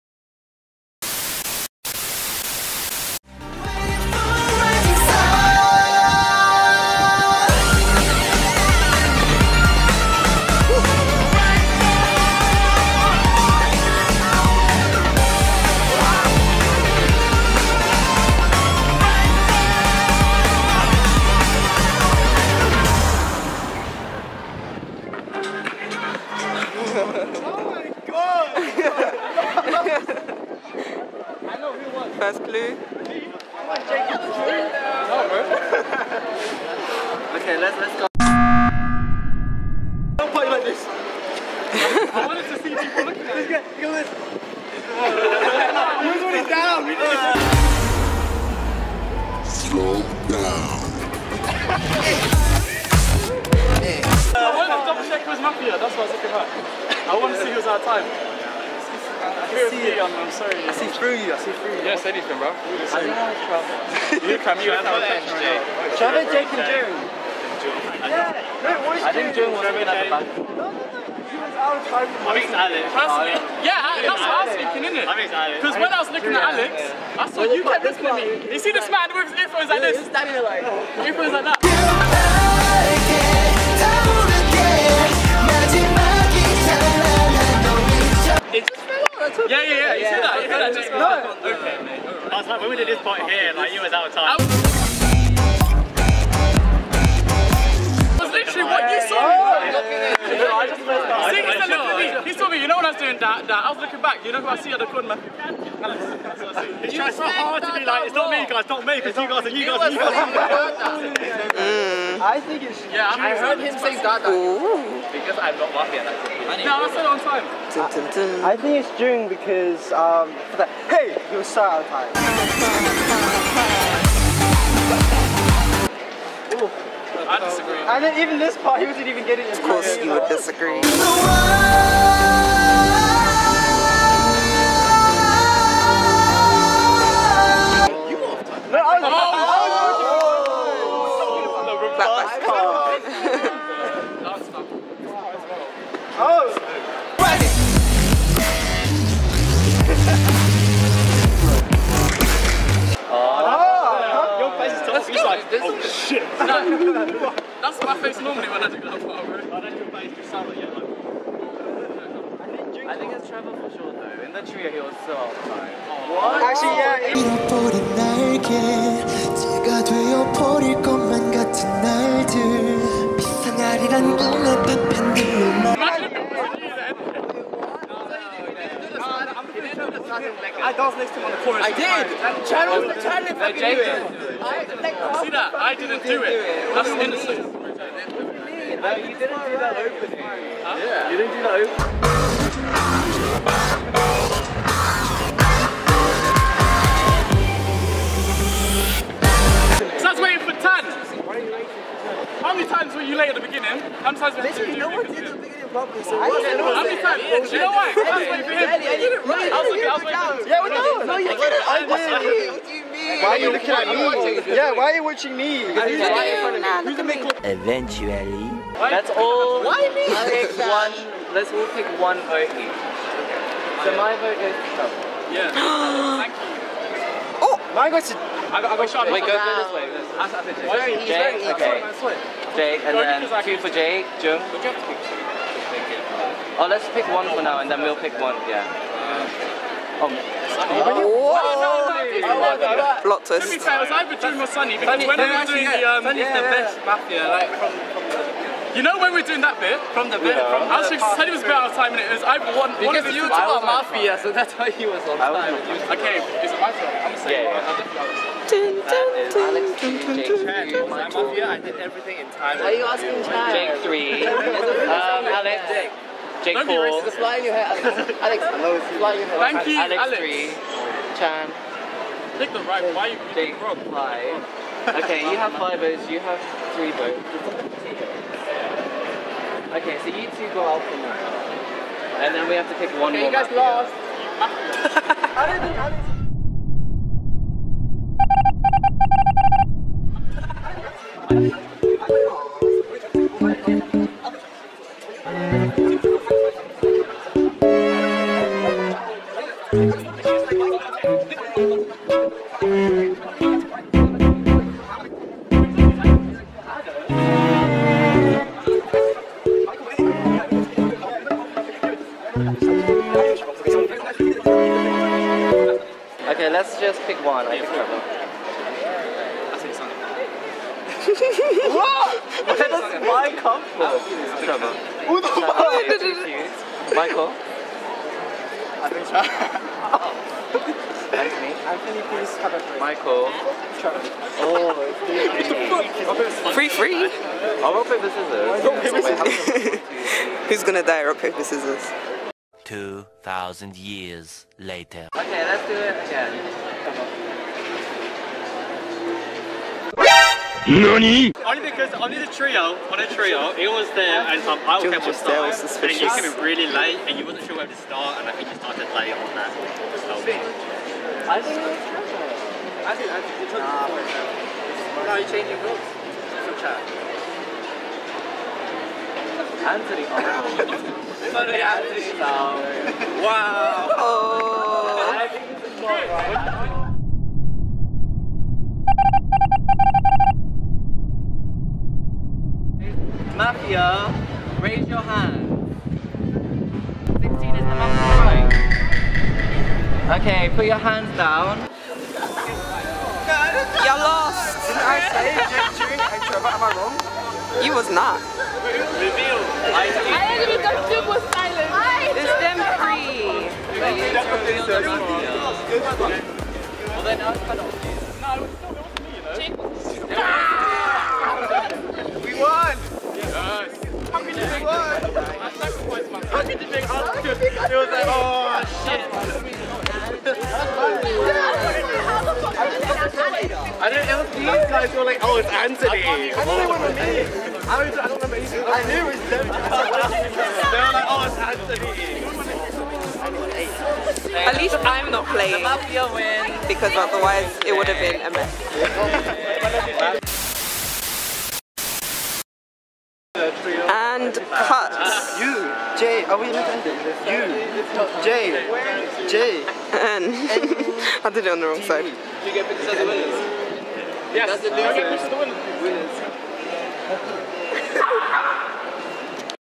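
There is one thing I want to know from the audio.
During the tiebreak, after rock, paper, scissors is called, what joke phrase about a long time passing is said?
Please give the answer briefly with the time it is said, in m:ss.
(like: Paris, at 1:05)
2,000 years later, at 5:42.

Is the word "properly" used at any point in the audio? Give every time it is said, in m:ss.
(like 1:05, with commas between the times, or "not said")
3:25.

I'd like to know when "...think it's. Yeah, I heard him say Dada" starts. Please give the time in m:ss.
1:52.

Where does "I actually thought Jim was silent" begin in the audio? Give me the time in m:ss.
6:39.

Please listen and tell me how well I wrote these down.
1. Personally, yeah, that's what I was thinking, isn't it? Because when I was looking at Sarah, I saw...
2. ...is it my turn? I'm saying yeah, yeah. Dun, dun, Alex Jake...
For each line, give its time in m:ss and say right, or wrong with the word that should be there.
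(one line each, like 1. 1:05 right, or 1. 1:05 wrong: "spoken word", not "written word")
1. 1:12 wrong: "Alex", not "Sarah"
2. 4:16 right.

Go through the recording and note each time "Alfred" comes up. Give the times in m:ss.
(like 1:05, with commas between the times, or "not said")
not said.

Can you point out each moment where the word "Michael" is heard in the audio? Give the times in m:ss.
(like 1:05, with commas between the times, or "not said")
5:26, 5:32.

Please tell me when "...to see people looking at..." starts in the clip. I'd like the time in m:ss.
0:42.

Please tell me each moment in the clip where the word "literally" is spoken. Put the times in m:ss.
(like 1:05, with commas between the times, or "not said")
1:38, 3:24.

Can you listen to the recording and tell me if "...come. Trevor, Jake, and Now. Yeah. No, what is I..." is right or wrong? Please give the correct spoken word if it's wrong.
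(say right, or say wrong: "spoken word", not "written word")
wrong: "June", not "Now".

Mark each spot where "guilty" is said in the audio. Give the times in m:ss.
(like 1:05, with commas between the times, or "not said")
not said.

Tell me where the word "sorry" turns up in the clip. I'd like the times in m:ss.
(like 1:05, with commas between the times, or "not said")
1:00, 6:11.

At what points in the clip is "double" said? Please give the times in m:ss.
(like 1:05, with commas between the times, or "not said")
0:54.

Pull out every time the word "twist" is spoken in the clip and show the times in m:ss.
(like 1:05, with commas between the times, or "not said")
4:03.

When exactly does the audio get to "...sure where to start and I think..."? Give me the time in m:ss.
5:57.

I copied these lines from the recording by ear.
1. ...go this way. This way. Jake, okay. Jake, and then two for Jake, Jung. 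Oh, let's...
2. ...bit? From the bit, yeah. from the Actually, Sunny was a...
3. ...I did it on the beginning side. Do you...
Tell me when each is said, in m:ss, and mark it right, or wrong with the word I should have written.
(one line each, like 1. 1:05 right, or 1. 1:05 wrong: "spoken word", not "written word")
1. 3:49 right
2. 4:09 right
3. 7:31 wrong: "wrong", not "beginning".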